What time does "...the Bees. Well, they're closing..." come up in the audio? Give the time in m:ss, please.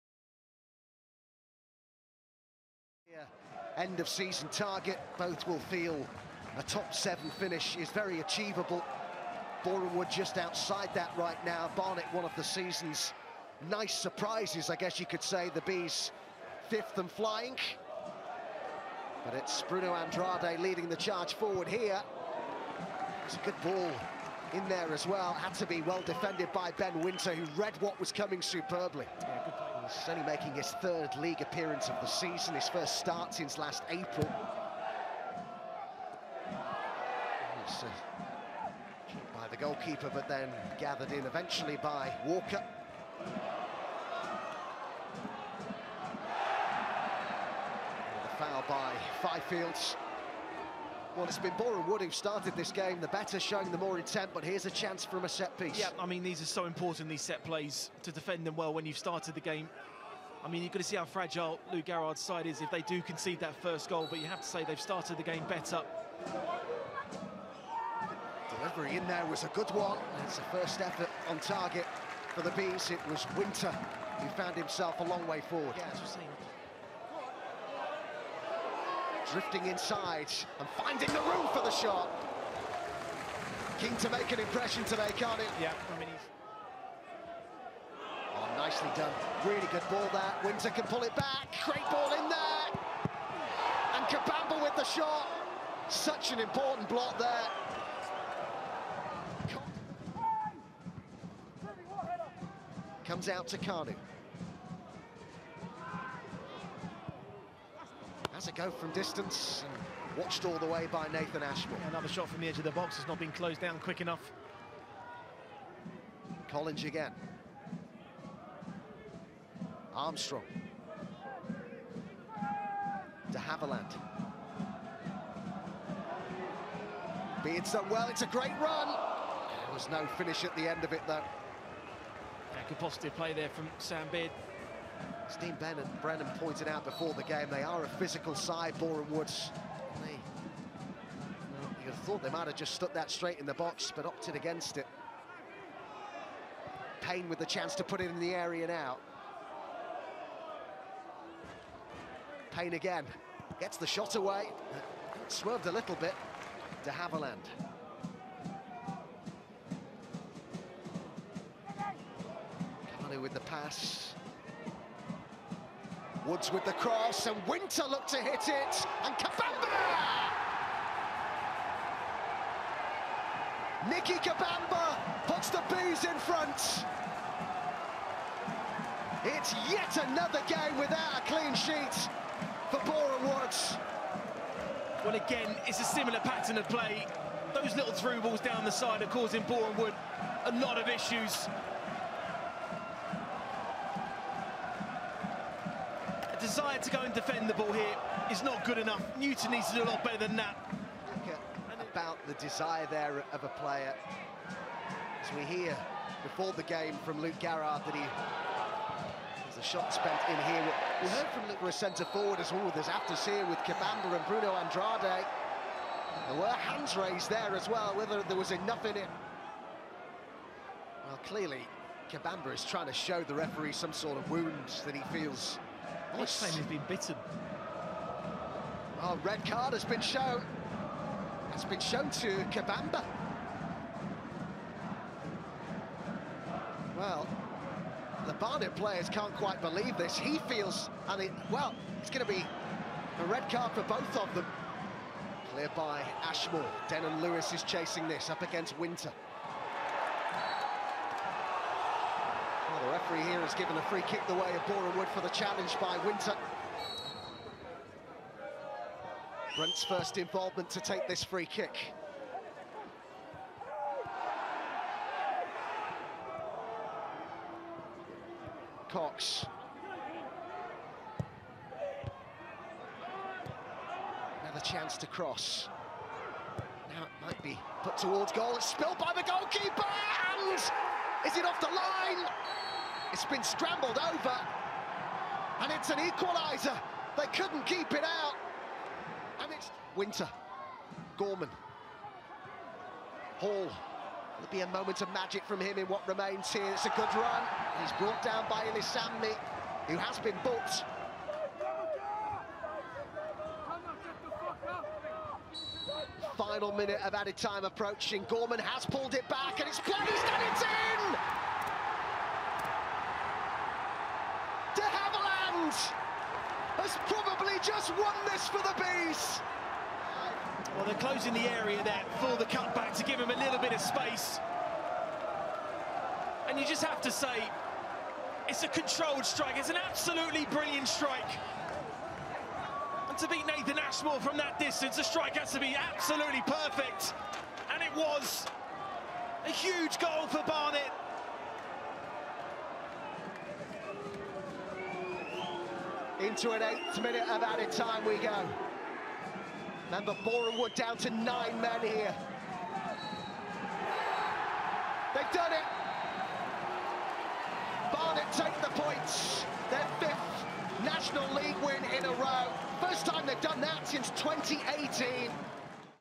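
5:18.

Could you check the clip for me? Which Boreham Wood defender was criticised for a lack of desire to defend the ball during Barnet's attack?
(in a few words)
Newton.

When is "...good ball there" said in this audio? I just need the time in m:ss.
1:29.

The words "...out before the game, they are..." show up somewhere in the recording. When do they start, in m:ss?
2:16.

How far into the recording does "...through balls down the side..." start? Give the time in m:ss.
3:07.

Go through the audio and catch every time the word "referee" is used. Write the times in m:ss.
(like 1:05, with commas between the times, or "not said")
3:43, 4:13.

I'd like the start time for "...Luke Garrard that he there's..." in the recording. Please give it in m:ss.
3:27.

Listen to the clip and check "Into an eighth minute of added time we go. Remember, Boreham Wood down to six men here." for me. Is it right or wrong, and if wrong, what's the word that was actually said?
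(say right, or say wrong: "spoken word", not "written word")
wrong: "nine", not "six".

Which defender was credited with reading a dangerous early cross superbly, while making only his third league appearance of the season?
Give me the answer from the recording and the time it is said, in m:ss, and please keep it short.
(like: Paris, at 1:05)
Ben Winter, at 0:26.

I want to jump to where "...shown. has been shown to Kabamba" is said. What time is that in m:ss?
3:50.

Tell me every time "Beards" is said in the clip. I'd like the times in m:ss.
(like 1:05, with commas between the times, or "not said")
2:07, 2:14.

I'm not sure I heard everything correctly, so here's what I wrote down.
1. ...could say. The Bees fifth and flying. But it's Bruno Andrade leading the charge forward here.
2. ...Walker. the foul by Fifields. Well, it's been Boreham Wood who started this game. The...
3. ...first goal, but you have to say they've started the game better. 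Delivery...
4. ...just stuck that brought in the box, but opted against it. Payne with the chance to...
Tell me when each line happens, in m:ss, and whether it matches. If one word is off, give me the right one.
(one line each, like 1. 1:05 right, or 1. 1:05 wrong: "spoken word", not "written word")
1. 0:15 right
2. 0:42 right
3. 1:03 right
4. 2:22 wrong: "straight", not "brought".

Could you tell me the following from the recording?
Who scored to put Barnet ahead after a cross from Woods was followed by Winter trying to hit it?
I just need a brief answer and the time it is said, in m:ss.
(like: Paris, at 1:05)
Nicke Kabamba, at 2:53.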